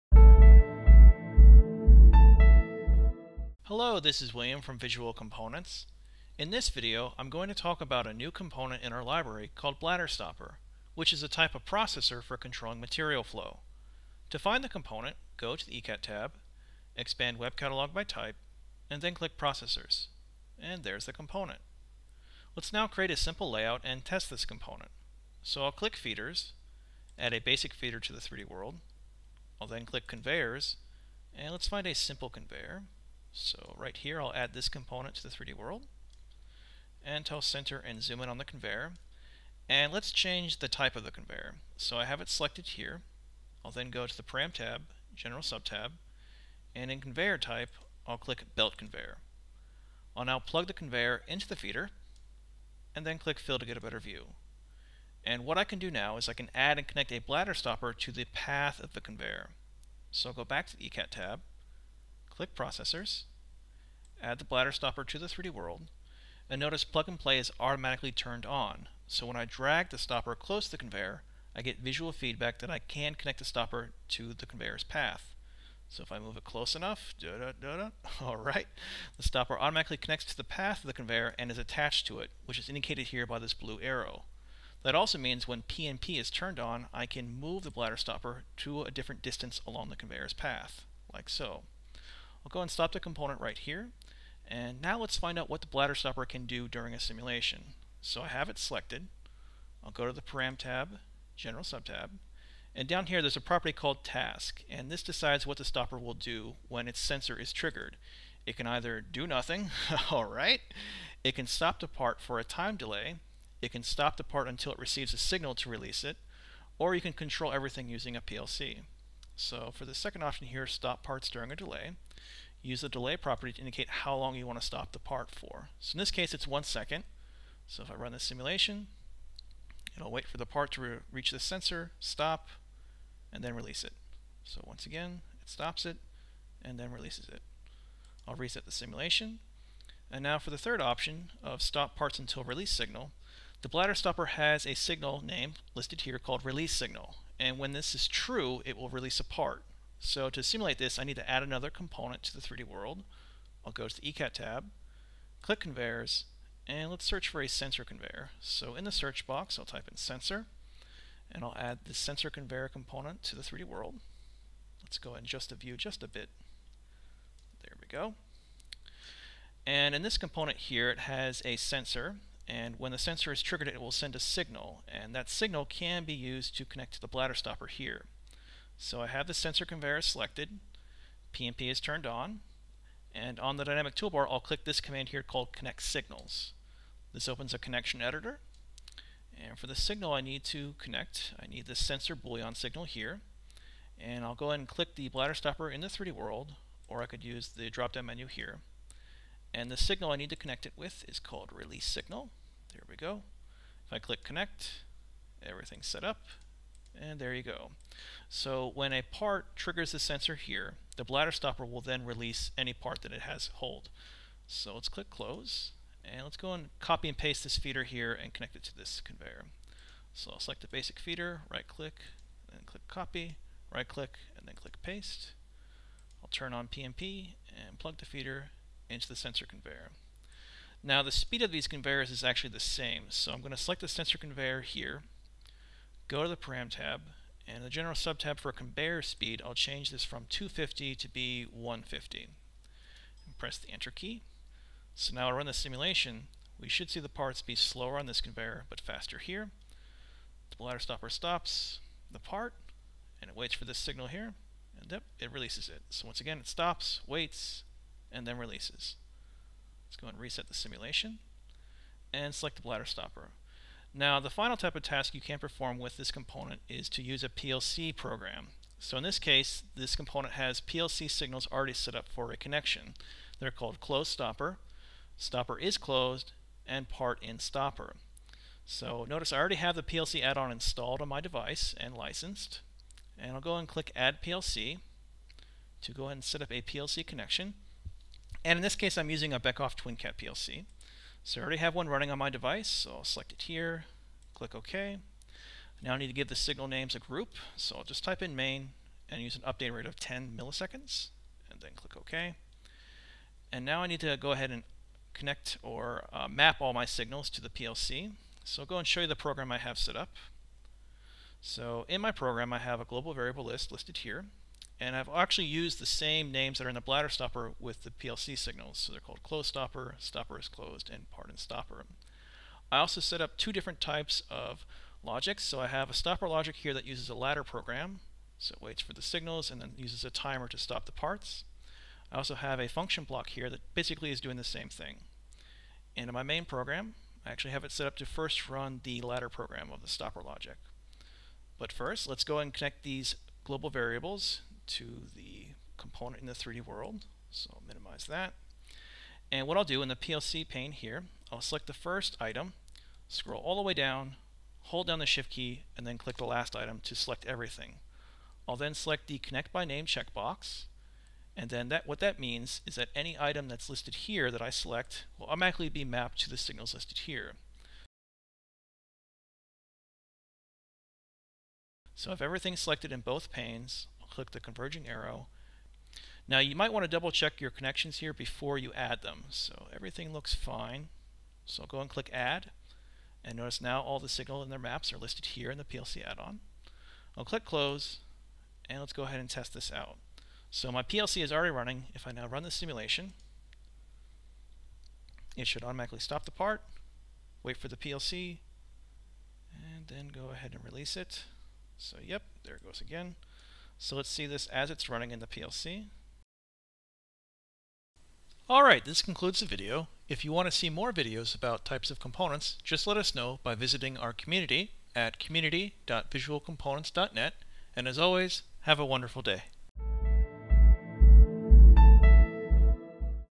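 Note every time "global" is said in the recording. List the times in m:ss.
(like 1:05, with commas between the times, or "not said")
5:12, 5:43.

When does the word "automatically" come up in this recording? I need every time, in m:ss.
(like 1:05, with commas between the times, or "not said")
1:07, 1:19, 6:05, 6:35.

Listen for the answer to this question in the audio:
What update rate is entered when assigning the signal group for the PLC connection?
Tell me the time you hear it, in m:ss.
4:59.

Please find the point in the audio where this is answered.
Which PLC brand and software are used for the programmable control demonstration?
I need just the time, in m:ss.
4:49.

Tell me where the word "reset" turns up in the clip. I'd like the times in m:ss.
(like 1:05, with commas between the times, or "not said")
2:18, 4:20.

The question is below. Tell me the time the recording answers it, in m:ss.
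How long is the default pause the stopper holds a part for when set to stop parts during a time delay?
2:06.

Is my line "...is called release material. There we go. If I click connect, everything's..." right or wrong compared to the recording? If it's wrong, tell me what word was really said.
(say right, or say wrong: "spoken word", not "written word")
wrong: "signal", not "material".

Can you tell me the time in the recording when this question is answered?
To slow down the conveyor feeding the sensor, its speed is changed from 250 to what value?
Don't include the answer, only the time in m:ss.
4:01.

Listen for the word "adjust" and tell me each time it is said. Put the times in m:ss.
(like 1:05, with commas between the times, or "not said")
2:45.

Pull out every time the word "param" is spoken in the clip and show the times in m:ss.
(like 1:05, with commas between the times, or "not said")
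0:44, 1:40, 3:56.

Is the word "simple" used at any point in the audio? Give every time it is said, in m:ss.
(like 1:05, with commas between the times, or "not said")
0:23, 0:31.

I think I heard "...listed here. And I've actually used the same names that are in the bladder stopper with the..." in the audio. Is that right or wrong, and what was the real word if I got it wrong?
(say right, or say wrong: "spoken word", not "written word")
right.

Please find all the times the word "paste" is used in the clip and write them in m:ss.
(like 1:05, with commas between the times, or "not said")
3:37, 3:44.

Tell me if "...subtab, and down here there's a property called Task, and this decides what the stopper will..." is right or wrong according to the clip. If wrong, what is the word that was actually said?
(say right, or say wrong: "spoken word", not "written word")
right.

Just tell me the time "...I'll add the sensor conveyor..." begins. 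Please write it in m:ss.
2:41.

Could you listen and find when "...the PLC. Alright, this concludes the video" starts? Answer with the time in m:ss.
6:45.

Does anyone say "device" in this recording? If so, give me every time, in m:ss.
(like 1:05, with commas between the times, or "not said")
4:41, 4:52.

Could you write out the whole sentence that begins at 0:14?
To find the component, go to the ECAT tab, expand Web Catalog by type, and then click Processors.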